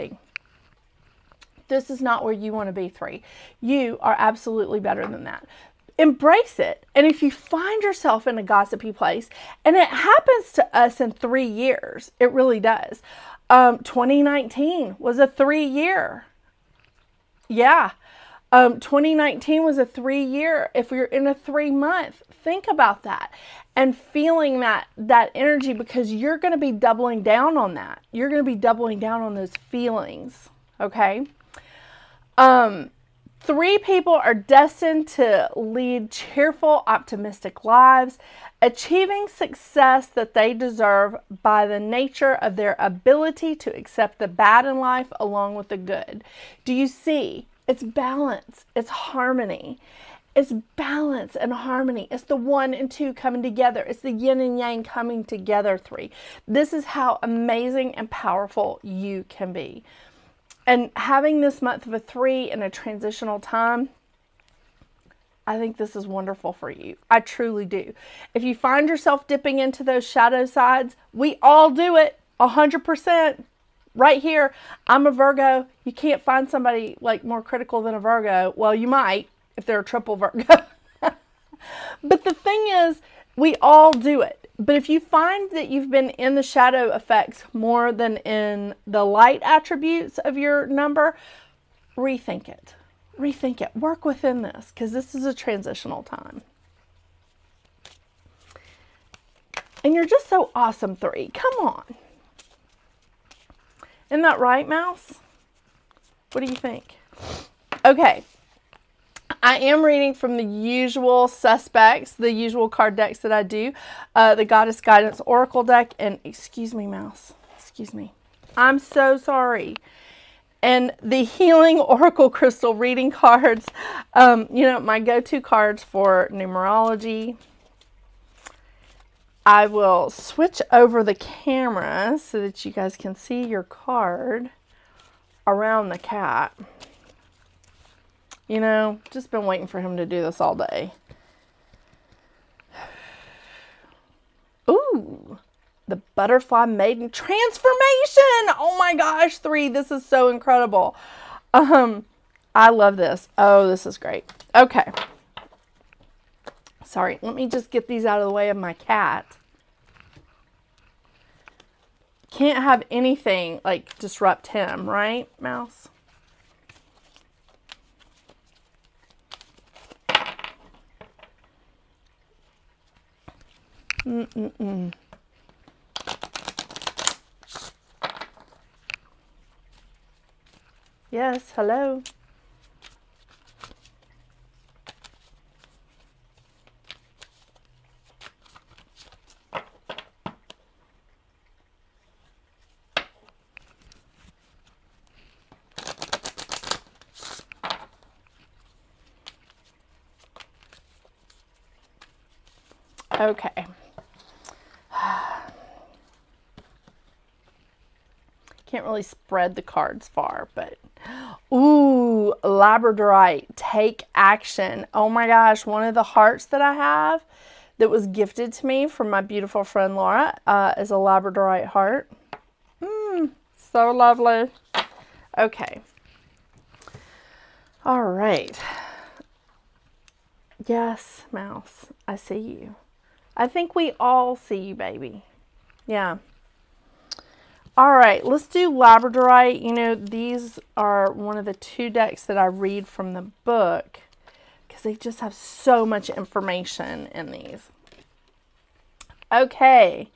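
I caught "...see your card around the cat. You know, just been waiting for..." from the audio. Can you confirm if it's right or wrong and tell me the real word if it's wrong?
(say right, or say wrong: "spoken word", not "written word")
right.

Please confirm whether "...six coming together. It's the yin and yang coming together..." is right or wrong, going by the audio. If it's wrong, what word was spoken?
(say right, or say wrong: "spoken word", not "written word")
wrong: "two", not "six".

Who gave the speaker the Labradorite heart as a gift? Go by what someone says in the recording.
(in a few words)
Laura.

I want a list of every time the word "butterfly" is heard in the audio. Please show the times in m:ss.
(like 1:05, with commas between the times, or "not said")
2:26.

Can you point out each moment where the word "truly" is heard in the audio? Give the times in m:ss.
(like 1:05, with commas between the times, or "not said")
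1:07.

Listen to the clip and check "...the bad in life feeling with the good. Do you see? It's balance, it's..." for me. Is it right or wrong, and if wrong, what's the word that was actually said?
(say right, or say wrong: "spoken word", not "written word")
wrong: "along", not "feeling".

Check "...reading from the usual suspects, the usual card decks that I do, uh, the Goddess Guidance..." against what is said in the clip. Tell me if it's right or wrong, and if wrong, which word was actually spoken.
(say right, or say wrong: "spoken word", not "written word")
right.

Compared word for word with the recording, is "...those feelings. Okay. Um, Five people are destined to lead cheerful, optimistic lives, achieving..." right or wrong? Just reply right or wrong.
wrong.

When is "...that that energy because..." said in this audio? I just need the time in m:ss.
0:24.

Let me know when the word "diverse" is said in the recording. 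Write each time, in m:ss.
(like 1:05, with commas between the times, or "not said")
not said.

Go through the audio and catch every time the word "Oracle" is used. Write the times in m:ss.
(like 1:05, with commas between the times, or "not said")
1:55, 2:01.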